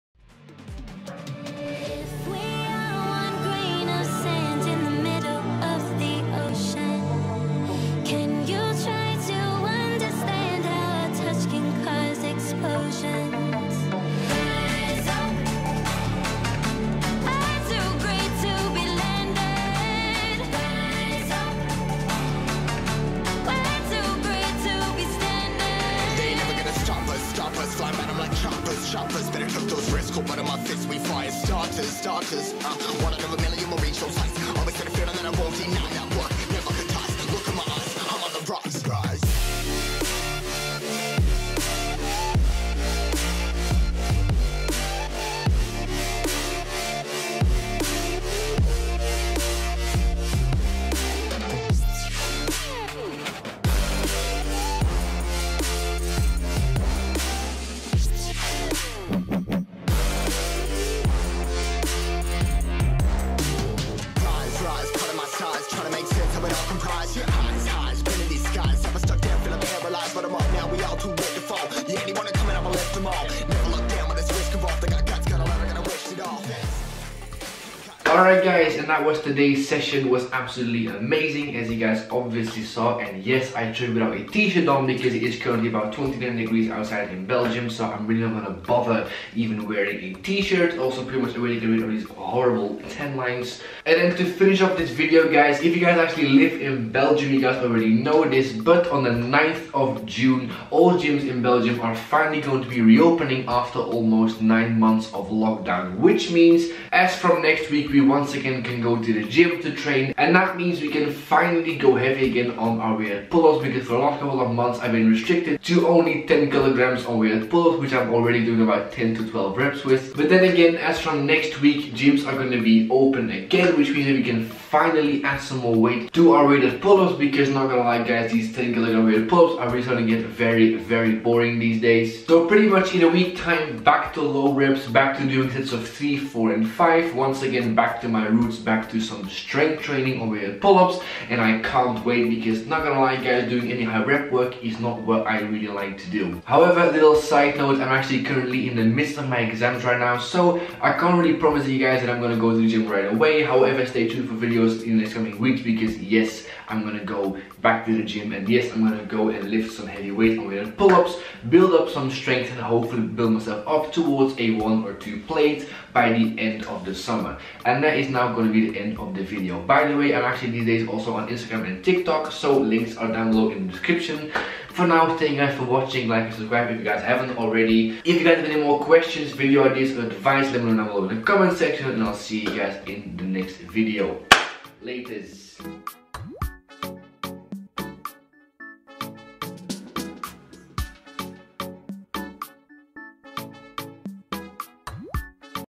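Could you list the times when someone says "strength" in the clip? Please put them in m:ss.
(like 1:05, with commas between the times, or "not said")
2:19, 2:42.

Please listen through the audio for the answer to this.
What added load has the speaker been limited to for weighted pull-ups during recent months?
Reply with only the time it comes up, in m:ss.
1:56.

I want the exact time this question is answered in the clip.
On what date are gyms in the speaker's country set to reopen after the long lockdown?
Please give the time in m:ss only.
1:39.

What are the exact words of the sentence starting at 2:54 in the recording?
For now, thank you guys for watching, like and subscribe if you guys haven't already.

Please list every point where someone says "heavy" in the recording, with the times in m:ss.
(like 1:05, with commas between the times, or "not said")
1:51, 2:39.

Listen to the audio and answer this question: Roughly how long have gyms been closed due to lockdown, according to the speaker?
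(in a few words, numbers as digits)
almost 9 months.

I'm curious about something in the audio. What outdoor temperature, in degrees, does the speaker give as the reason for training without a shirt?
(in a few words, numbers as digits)
29.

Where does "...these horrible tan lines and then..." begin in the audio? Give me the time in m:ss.
1:31.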